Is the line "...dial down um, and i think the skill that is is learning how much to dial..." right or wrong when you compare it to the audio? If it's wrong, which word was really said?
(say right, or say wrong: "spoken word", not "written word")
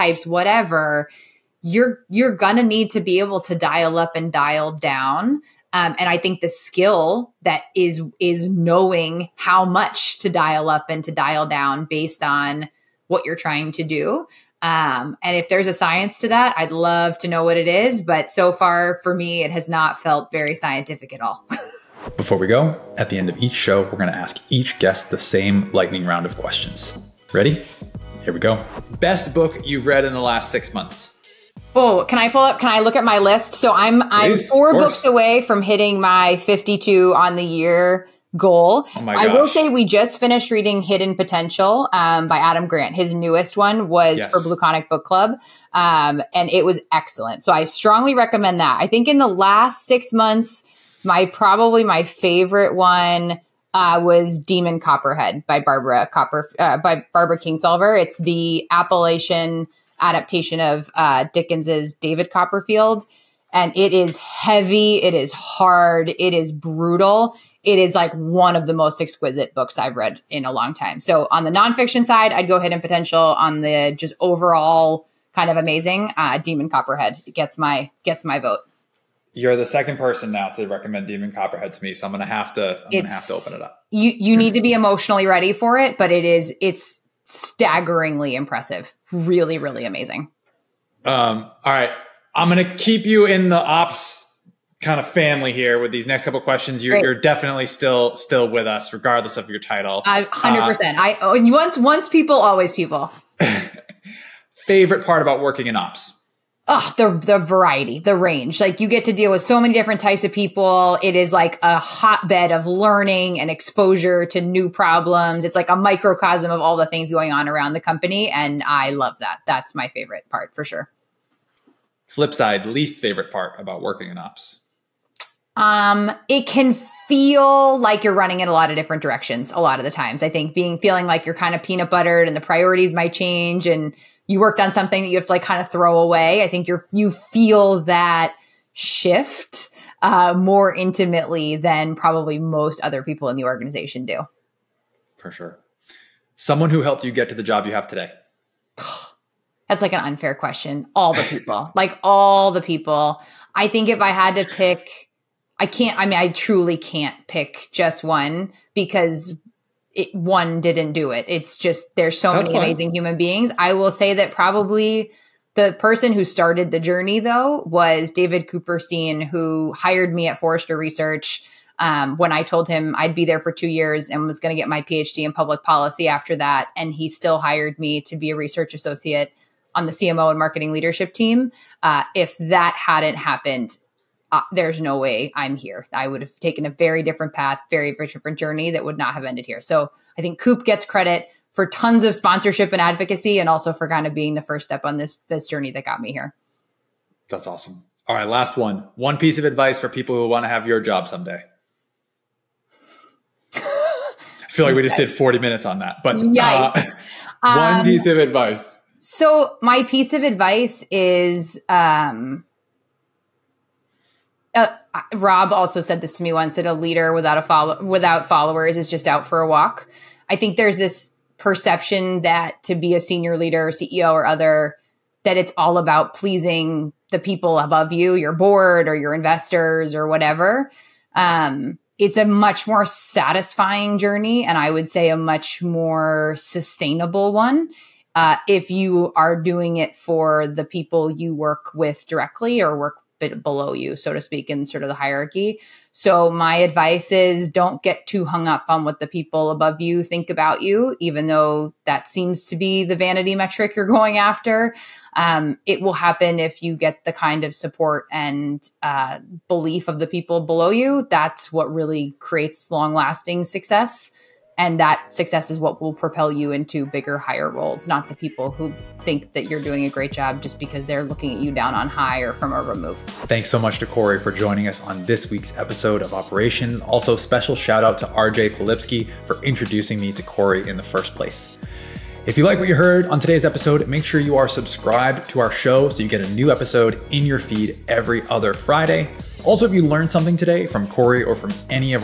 wrong: "knowing", not "learning".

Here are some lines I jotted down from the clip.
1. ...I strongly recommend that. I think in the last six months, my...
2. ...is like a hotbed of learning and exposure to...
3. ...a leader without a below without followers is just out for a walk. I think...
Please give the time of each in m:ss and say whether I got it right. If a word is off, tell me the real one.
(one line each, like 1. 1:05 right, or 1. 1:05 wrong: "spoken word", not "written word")
1. 0:47 right
2. 1:51 right
3. 3:36 wrong: "follow", not "below".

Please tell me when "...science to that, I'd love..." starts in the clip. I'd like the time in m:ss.
0:15.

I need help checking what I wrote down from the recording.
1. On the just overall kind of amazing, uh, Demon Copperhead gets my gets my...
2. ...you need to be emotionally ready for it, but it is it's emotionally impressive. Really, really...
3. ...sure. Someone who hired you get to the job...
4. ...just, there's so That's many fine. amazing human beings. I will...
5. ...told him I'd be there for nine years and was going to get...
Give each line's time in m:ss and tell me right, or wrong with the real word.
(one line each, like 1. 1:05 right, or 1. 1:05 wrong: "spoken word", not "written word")
1. 1:13 right
2. 1:24 wrong: "staggeringly", not "emotionally"
3. 2:25 wrong: "helped", not "hired"
4. 2:41 right
5. 2:52 wrong: "two", not "nine".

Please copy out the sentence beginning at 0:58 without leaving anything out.
It's the Appalachian adaptation of uh, Dickens's David Copperfield, and it is heavy.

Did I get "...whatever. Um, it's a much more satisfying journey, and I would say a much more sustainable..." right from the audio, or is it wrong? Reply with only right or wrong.
right.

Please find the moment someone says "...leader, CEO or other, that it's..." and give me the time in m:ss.
3:43.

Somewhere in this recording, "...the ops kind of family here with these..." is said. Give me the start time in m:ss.
1:33.